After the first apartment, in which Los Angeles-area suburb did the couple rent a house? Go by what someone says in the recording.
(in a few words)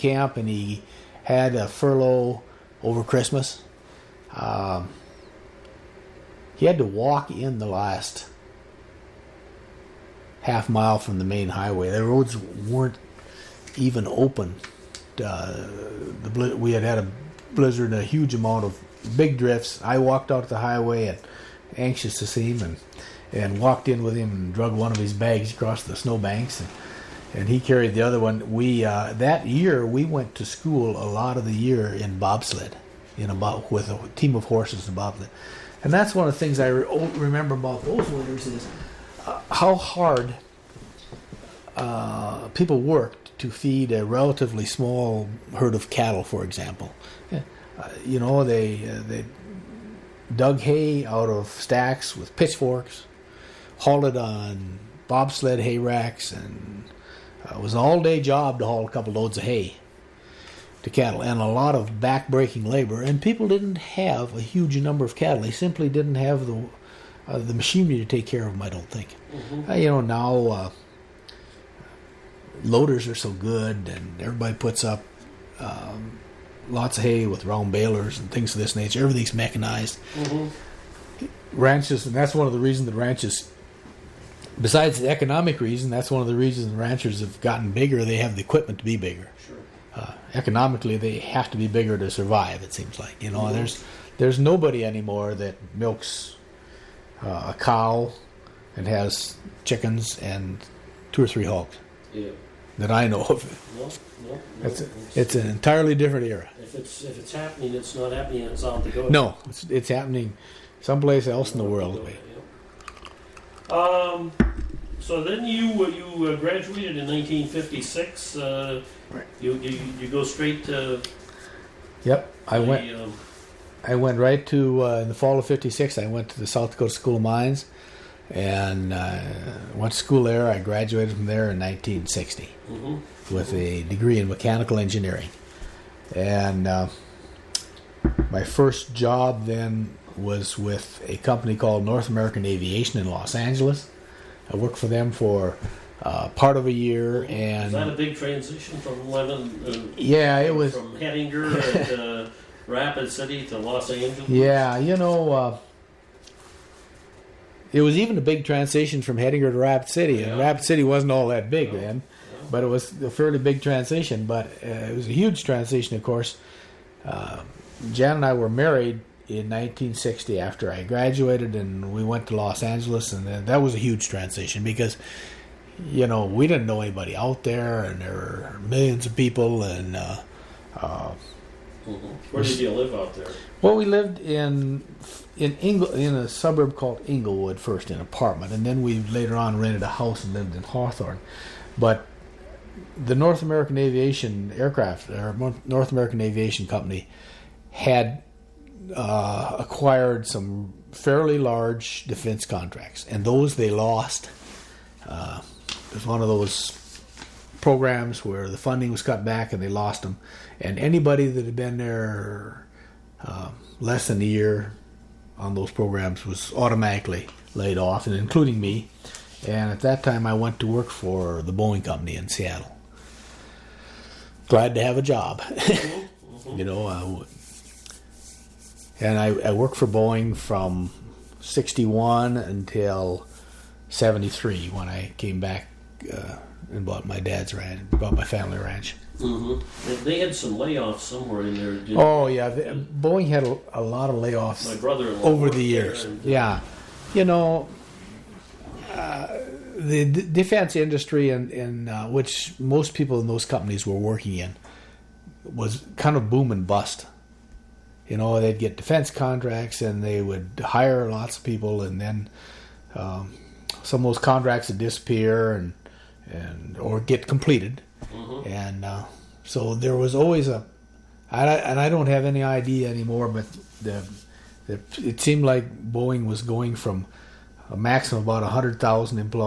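Hawthorne.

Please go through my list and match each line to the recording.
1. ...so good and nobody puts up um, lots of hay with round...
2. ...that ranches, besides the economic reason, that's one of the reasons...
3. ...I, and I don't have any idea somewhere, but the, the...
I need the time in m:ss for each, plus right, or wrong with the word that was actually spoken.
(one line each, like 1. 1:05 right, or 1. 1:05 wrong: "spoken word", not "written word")
1. 1:13 wrong: "everybody", not "nobody"
2. 1:22 right
3. 4:31 wrong: "anymore", not "somewhere".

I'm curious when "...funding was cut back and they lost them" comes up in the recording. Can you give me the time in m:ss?
3:28.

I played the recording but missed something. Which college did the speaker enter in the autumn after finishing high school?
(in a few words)
South Dakota School of Mines.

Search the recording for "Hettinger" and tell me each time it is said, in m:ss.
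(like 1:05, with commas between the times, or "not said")
2:30, 2:39.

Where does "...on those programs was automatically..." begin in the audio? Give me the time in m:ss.
3:35.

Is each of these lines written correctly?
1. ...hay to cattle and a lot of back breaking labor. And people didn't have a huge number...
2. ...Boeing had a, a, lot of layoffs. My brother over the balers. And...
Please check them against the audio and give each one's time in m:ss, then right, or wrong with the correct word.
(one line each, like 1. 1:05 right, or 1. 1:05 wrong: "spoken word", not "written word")
1. 0:59 right
2. 4:02 wrong: "years", not "balers".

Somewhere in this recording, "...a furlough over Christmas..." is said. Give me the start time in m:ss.
0:01.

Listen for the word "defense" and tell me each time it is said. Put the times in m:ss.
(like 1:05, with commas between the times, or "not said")
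3:22, 4:10, 4:18.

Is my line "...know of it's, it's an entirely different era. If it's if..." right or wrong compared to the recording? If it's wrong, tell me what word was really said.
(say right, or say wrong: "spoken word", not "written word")
right.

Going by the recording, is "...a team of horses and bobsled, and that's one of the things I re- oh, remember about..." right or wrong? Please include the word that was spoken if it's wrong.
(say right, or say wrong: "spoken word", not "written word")
right.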